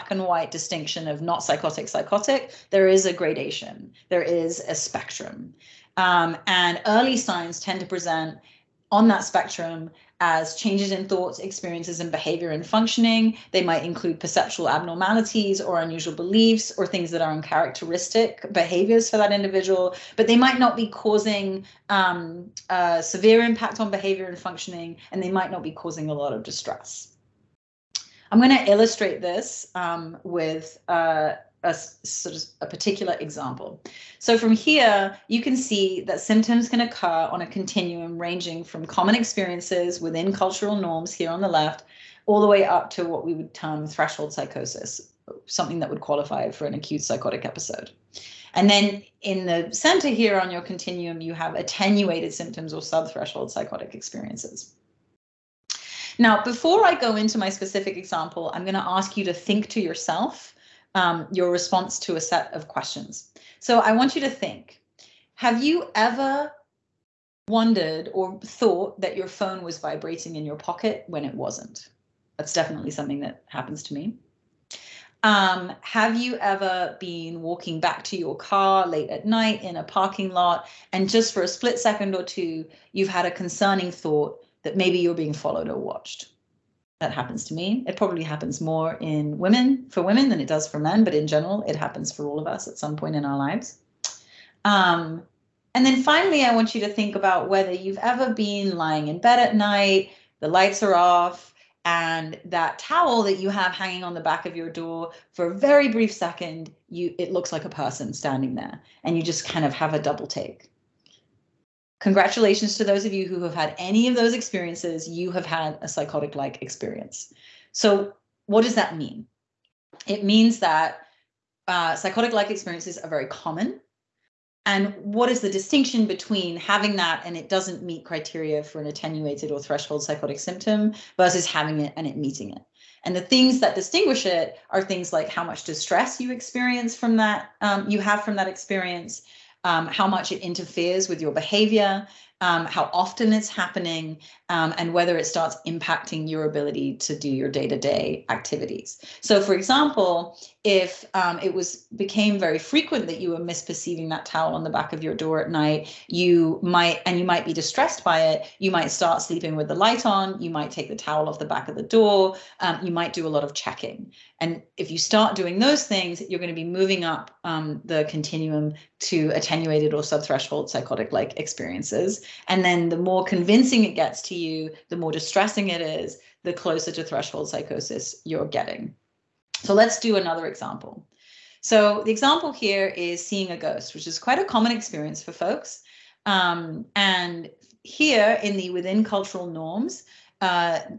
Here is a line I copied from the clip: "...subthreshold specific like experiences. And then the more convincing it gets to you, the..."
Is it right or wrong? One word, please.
wrong.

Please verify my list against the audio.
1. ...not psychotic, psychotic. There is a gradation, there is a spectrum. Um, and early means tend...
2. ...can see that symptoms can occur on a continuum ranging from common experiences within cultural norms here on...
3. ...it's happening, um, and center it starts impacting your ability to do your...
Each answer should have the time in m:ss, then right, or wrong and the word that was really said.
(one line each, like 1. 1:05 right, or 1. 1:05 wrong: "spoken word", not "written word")
1. 0:01 wrong: "signs", not "means"
2. 0:35 right
3. 2:23 wrong: "whether", not "center".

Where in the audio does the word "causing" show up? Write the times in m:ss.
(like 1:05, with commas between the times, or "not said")
0:20, 0:25.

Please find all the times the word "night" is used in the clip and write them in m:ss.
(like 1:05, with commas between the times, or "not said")
1:19, 1:39, 2:35.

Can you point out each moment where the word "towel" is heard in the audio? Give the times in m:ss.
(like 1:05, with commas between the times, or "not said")
1:42, 2:34, 2:40.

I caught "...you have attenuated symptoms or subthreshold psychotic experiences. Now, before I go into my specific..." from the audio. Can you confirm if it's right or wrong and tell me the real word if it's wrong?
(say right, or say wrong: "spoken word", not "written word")
right.